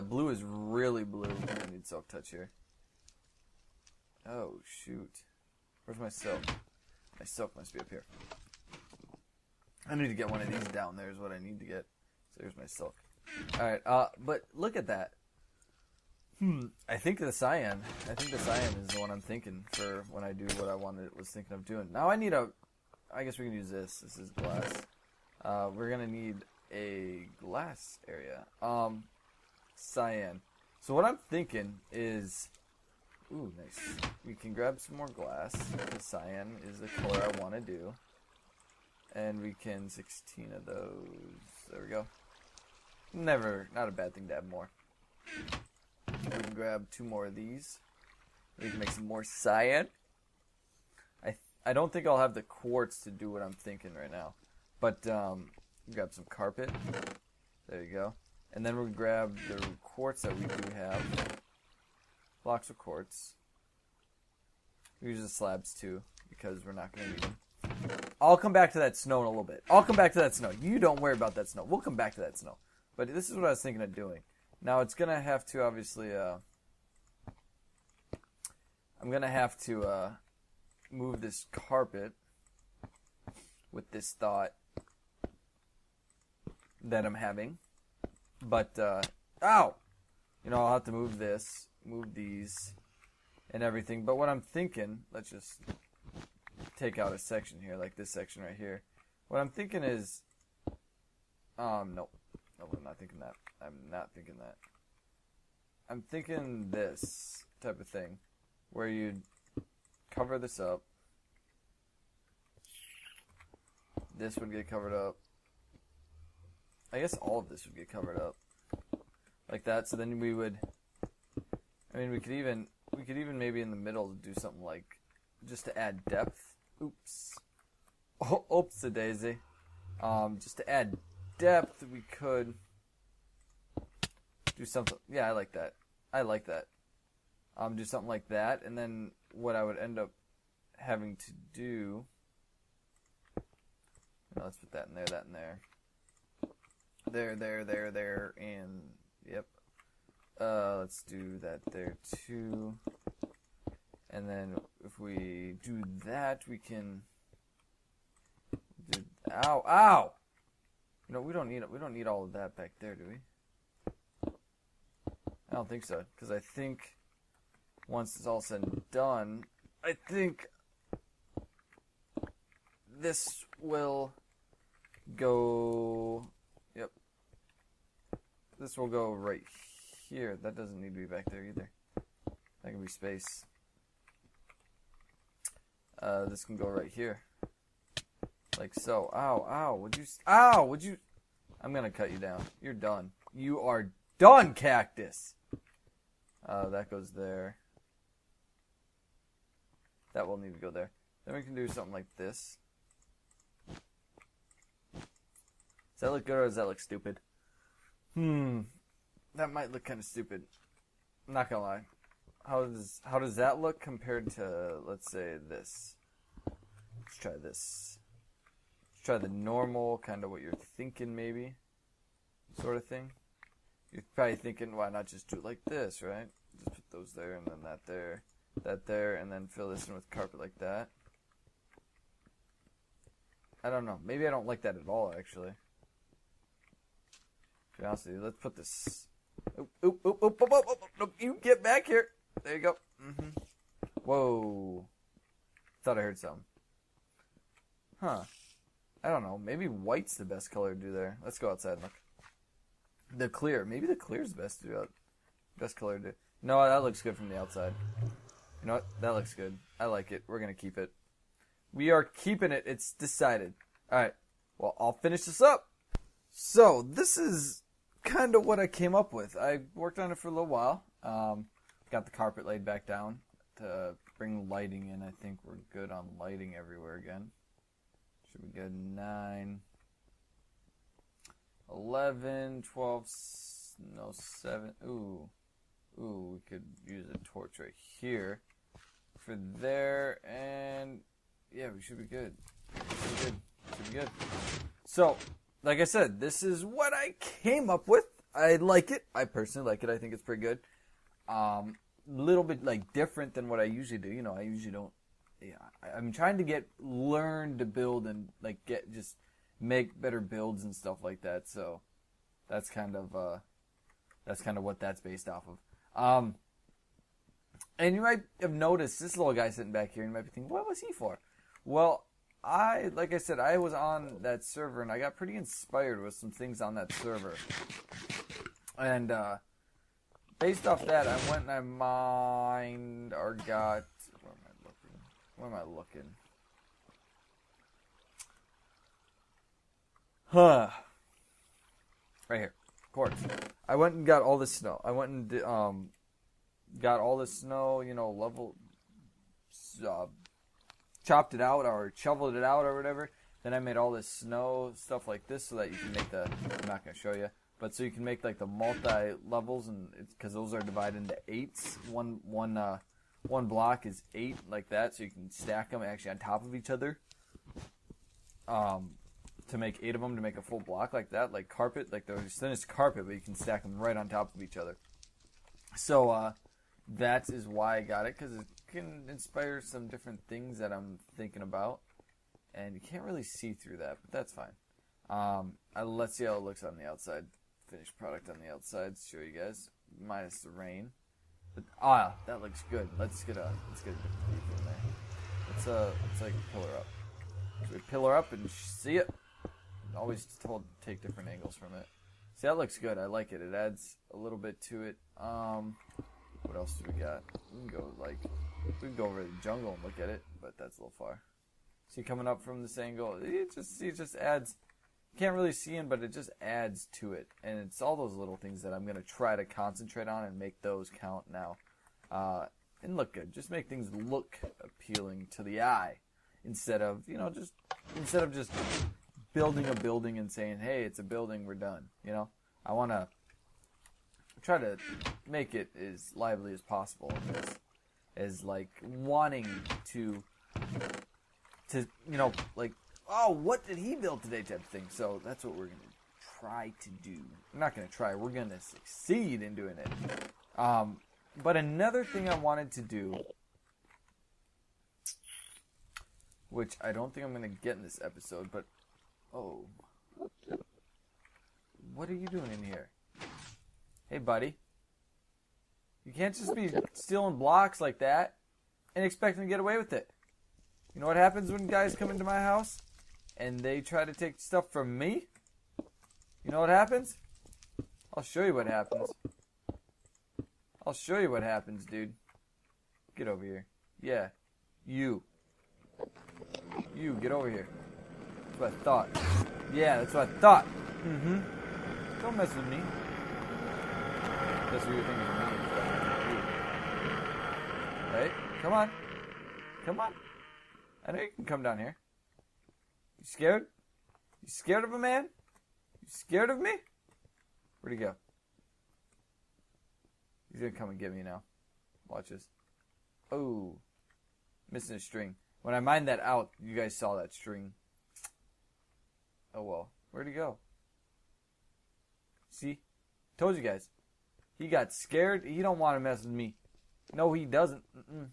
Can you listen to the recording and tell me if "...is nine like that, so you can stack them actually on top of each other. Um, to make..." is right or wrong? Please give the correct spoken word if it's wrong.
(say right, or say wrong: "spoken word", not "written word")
wrong: "eight", not "nine".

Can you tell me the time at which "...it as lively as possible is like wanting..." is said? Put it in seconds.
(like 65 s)
435 s.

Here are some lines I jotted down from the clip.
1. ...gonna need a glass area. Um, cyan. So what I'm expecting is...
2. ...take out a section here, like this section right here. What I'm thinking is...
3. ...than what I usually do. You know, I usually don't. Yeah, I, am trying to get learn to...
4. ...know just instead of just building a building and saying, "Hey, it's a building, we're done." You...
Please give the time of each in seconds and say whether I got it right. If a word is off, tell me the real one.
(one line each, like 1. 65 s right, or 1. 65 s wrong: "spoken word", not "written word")
1. 25 s wrong: "thinking", not "expecting"
2. 96 s right
3. 303 s right
4. 427 s right.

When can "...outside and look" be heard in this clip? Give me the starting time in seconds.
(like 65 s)
251 s.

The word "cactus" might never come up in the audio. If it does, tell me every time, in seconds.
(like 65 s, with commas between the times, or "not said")
194 s.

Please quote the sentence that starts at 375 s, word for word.
So uh, that is why I got it because it can inspire some different things that I'm thinking about.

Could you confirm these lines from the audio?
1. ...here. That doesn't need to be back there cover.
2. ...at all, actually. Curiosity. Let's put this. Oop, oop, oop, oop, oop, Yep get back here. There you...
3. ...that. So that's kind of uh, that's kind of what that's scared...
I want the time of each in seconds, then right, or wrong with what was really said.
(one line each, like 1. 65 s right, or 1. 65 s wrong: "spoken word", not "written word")
1. 180 s wrong: "either", not "cover"
2. 234 s wrong: "You", not "Yep"
3. 311 s wrong: "based", not "scared".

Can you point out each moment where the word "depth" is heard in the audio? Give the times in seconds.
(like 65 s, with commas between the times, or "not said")
126 s, 131 s.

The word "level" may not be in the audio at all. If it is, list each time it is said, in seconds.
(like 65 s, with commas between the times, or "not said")
348 s, 359 s.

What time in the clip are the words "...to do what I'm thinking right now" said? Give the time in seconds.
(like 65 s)
53 s.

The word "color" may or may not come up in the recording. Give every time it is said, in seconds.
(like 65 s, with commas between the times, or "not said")
36 s, 250 s, 255 s.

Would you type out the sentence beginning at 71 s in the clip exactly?
We'll come back to that snow.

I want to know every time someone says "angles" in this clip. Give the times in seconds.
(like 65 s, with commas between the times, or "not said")
401 s, 412 s.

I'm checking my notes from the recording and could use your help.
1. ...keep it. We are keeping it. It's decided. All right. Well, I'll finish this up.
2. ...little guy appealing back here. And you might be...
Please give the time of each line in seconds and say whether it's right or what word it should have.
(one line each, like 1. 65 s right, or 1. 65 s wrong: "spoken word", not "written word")
1. 260 s right
2. 319 s wrong: "sitting", not "appealing".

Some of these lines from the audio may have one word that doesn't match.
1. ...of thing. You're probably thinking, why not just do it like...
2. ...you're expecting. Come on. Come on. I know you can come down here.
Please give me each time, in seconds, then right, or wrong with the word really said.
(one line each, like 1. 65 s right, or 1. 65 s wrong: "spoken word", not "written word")
1. 222 s right
2. 494 s wrong: "thinking", not "expecting".